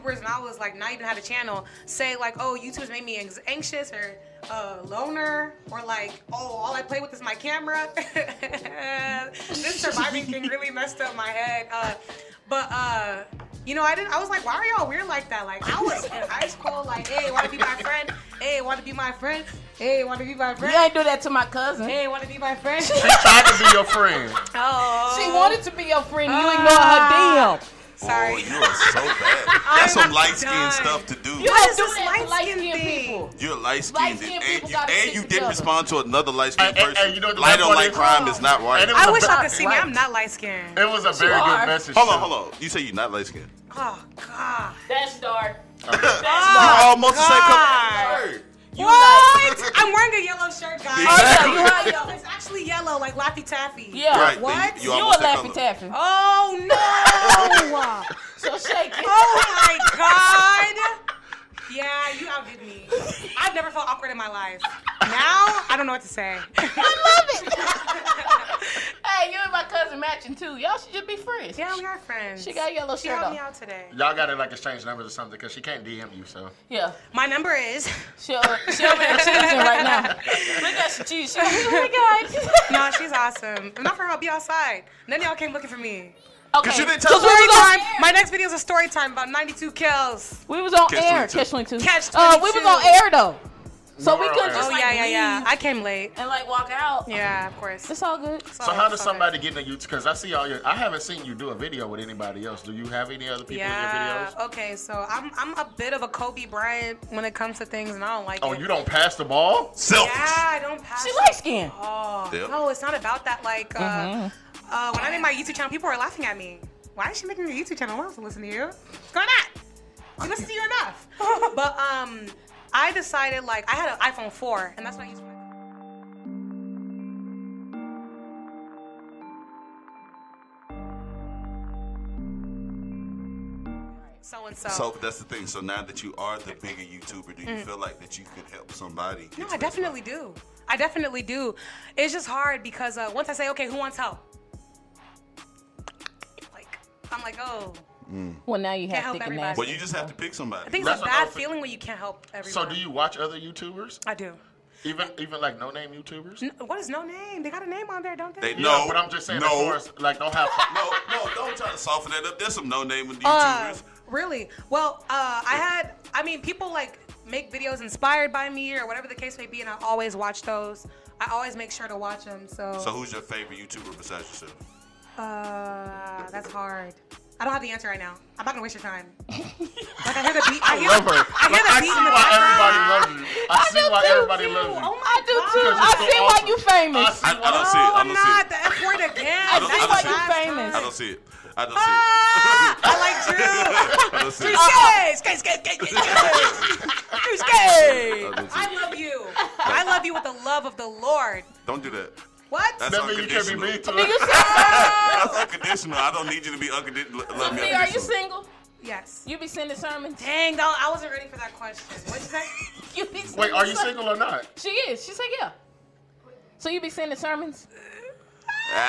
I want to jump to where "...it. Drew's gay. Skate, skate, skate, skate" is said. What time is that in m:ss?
3:14.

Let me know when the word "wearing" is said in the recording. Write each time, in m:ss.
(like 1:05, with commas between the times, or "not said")
0:49.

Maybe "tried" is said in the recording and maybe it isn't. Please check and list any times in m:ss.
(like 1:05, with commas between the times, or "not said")
0:22.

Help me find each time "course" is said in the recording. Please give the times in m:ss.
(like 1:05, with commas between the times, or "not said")
1:37, 2:39.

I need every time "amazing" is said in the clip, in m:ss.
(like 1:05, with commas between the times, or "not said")
not said.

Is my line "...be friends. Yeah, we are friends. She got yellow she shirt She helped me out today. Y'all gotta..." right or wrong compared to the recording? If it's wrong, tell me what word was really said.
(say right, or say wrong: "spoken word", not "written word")
right.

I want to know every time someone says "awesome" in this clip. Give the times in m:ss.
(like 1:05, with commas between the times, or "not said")
1:23, 3:05.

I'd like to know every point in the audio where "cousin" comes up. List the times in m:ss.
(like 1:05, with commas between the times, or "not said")
0:21, 1:09.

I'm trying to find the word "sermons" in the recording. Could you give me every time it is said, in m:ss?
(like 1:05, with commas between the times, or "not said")
3:29, 3:37.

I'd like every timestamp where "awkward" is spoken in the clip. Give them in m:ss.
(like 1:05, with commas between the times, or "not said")
1:03.